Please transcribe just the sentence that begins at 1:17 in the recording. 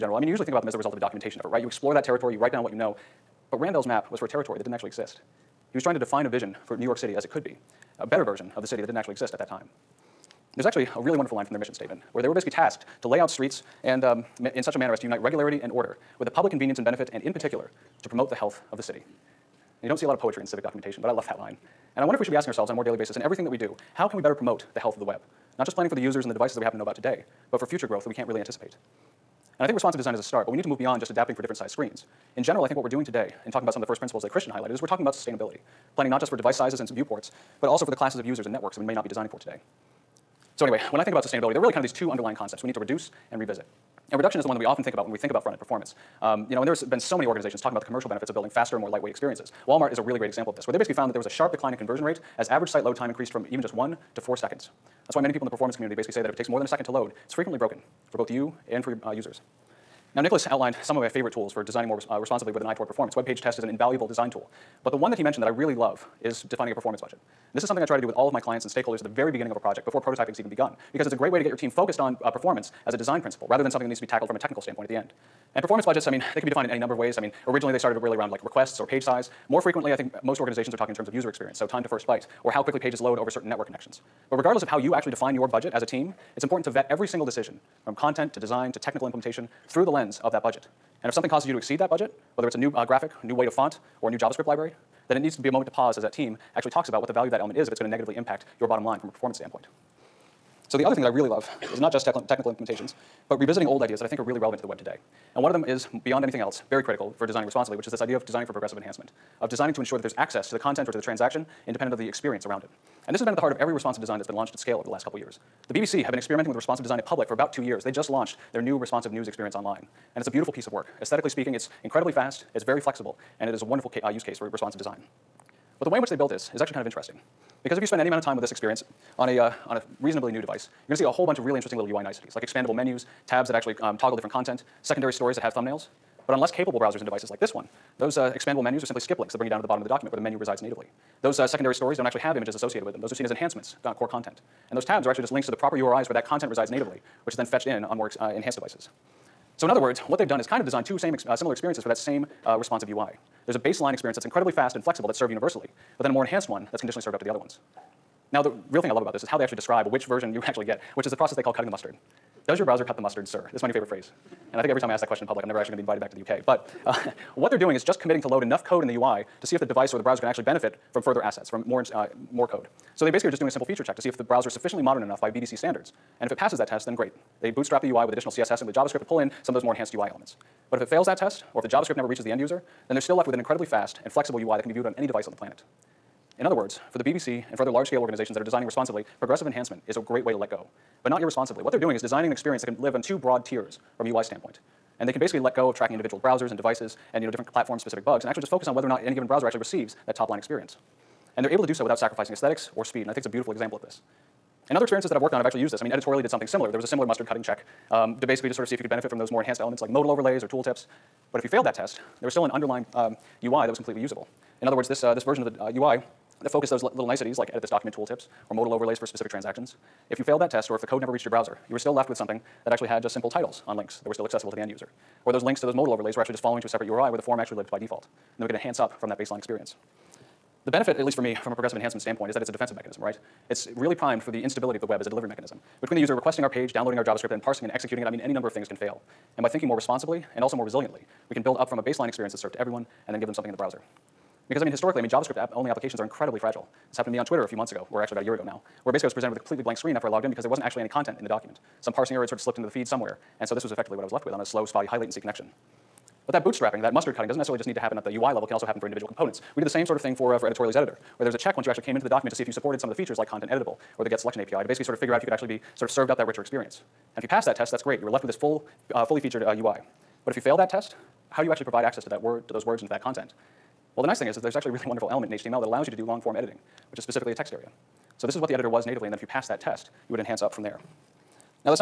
I mean, originally they started really around like requests or page size.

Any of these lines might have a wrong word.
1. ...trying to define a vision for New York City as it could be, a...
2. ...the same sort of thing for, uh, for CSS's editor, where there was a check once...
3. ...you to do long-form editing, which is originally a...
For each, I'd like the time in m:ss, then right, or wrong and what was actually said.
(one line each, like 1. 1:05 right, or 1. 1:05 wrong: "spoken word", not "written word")
1. 0:05 right
2. 4:19 wrong: "Editorially", not "CSS"
3. 4:35 wrong: "specifically", not "originally".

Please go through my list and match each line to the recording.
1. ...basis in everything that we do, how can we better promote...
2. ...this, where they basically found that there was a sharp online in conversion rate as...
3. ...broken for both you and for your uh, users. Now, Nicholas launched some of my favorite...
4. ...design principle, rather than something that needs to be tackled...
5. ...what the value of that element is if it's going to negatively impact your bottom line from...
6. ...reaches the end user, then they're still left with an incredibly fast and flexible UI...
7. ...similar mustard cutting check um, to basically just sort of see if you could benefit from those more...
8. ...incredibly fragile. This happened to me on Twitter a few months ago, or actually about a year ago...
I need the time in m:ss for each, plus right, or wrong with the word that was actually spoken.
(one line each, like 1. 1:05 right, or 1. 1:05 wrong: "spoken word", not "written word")
1. 0:22 right
2. 0:50 wrong: "decline", not "online"
3. 0:57 wrong: "outlined", not "launched"
4. 1:12 right
5. 1:37 right
6. 3:02 right
7. 3:26 right
8. 4:06 right.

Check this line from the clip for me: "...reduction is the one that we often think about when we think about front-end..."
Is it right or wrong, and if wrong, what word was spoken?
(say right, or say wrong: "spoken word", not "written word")
right.